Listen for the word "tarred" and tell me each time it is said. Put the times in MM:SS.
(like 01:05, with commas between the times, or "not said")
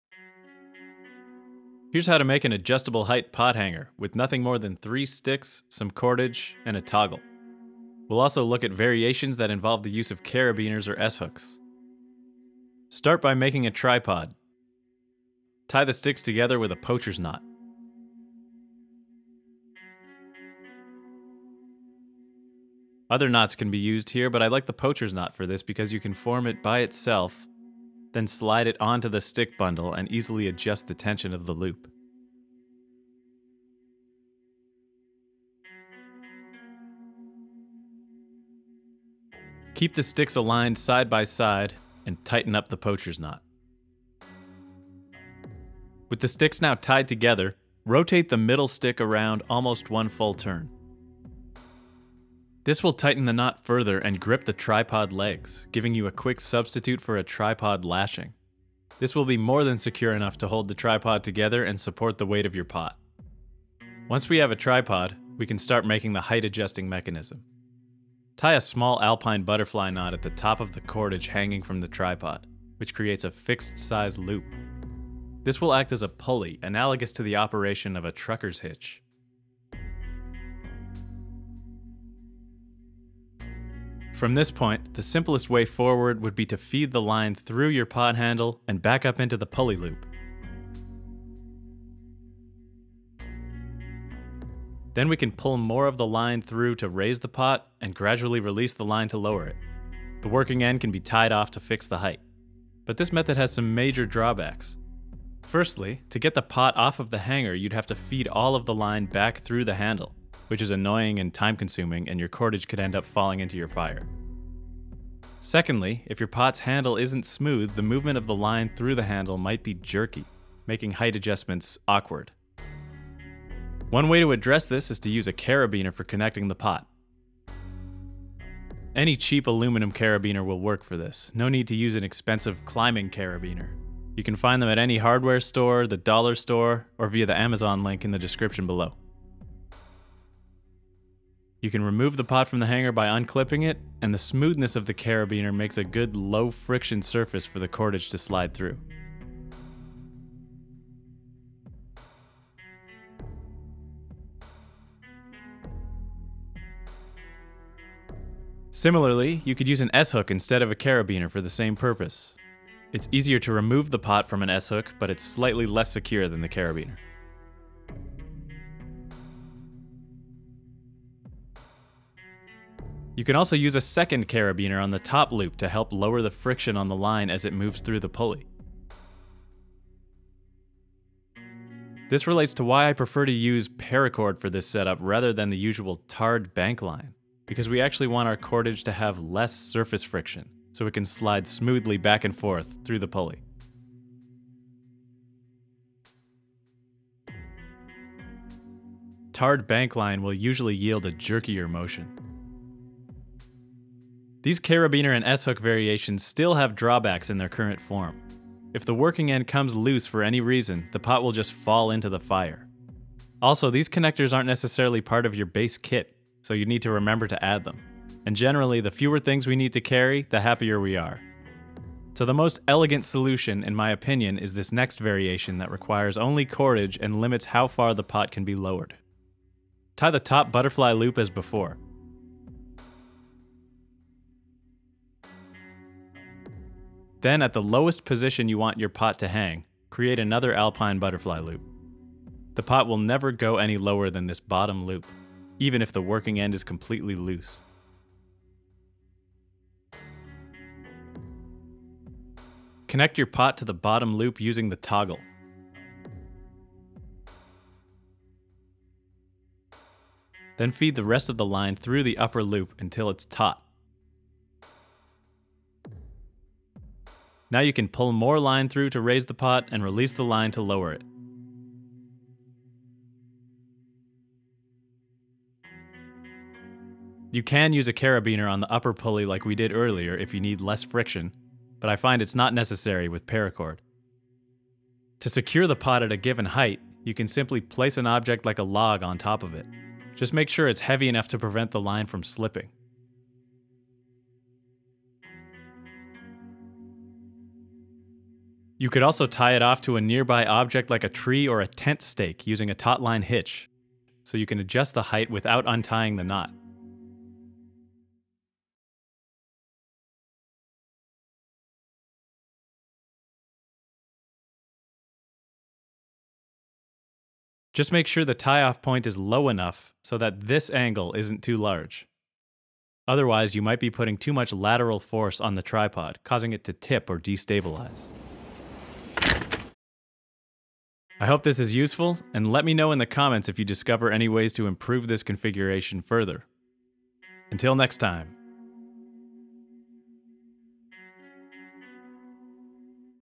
03:06, 03:19.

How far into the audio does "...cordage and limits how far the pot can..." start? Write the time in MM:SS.
03:46.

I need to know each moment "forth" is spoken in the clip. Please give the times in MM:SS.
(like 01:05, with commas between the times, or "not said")
03:12.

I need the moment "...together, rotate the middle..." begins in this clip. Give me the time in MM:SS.
00:47.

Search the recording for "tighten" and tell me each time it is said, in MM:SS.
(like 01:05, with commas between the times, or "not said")
00:42, 00:52.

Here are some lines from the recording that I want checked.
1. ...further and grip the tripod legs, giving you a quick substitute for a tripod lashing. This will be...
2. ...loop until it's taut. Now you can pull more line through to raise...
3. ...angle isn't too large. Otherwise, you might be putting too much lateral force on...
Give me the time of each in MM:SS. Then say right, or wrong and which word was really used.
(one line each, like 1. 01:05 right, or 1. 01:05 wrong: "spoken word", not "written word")
1. 00:53 right
2. 04:22 right
3. 05:20 right.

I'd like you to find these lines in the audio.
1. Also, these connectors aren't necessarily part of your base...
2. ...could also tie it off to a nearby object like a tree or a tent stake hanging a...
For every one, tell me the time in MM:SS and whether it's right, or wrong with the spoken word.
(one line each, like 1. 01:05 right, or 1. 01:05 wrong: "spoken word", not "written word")
1. 03:33 right
2. 04:58 wrong: "using", not "hanging".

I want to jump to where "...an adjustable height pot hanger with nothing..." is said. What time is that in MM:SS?
00:02.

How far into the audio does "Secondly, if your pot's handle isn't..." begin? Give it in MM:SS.
01:55.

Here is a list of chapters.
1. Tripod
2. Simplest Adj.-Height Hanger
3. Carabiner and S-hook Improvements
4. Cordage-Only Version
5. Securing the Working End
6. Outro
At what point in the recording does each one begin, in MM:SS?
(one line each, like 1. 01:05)
1. 00:12
2. 01:03
3. 02:03
4. 03:41
5. 04:45
6. 05:30.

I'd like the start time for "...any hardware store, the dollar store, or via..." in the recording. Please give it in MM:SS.
02:14.